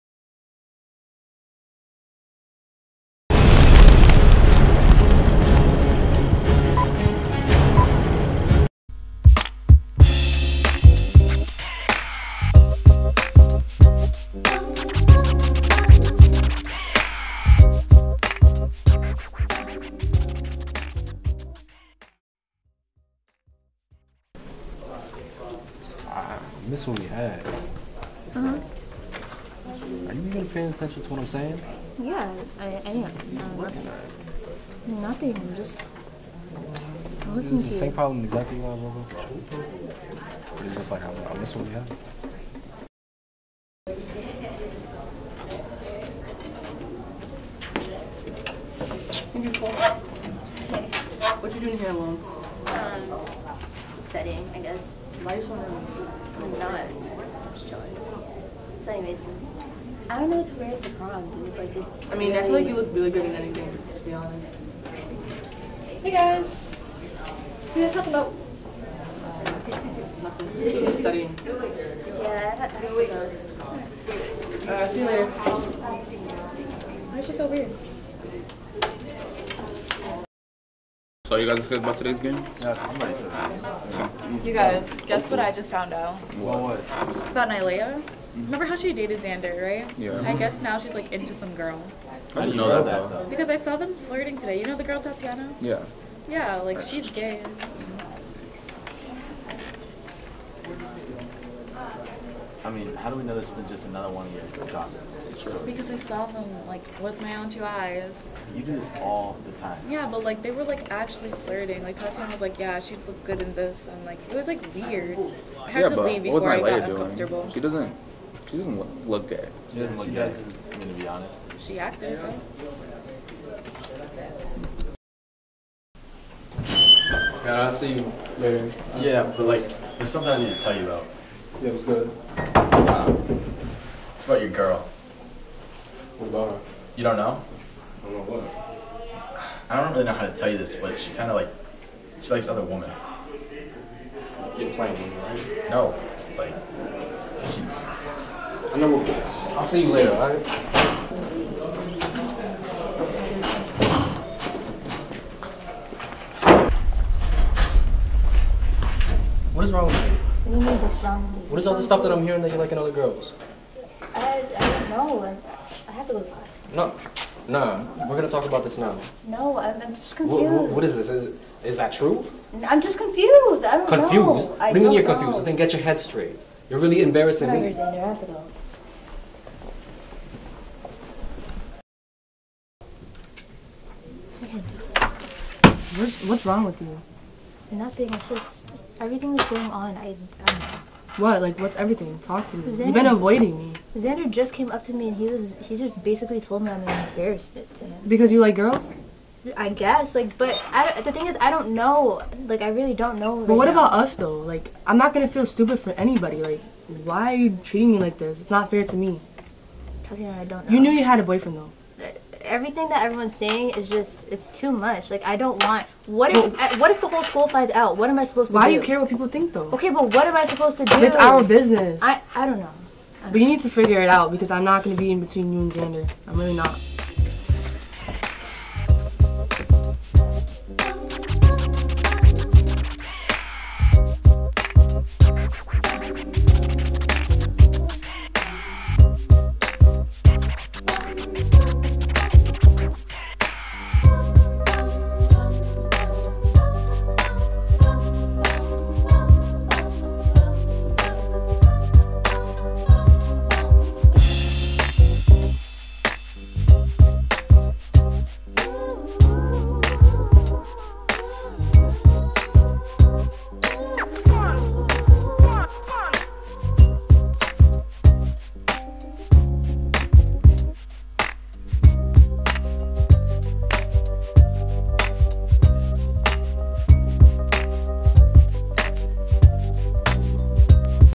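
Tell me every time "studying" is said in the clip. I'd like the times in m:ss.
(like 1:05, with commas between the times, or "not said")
0:54, 1:10.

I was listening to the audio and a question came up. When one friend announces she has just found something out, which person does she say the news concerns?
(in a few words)
Nylea.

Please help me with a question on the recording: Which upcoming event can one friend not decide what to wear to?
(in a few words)
prom.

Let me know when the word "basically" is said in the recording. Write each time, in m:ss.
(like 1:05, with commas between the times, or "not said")
3:16.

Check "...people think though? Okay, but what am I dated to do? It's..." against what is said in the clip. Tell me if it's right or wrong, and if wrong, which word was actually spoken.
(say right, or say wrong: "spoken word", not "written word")
wrong: "supposed", not "dated".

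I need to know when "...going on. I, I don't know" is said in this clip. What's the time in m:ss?
3:09.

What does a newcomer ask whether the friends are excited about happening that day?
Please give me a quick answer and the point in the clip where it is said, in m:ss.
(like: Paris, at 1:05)
today's game, at 1:21.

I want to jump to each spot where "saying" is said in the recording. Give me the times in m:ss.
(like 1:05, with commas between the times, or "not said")
0:31, 3:33.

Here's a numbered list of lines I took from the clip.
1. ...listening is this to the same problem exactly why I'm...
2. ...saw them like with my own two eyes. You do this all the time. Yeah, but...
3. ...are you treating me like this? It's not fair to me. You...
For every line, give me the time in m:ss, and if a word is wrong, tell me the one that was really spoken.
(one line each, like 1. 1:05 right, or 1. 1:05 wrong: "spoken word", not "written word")
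1. 0:37 right
2. 1:45 right
3. 3:27 right.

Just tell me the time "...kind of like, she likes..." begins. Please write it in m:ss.
2:21.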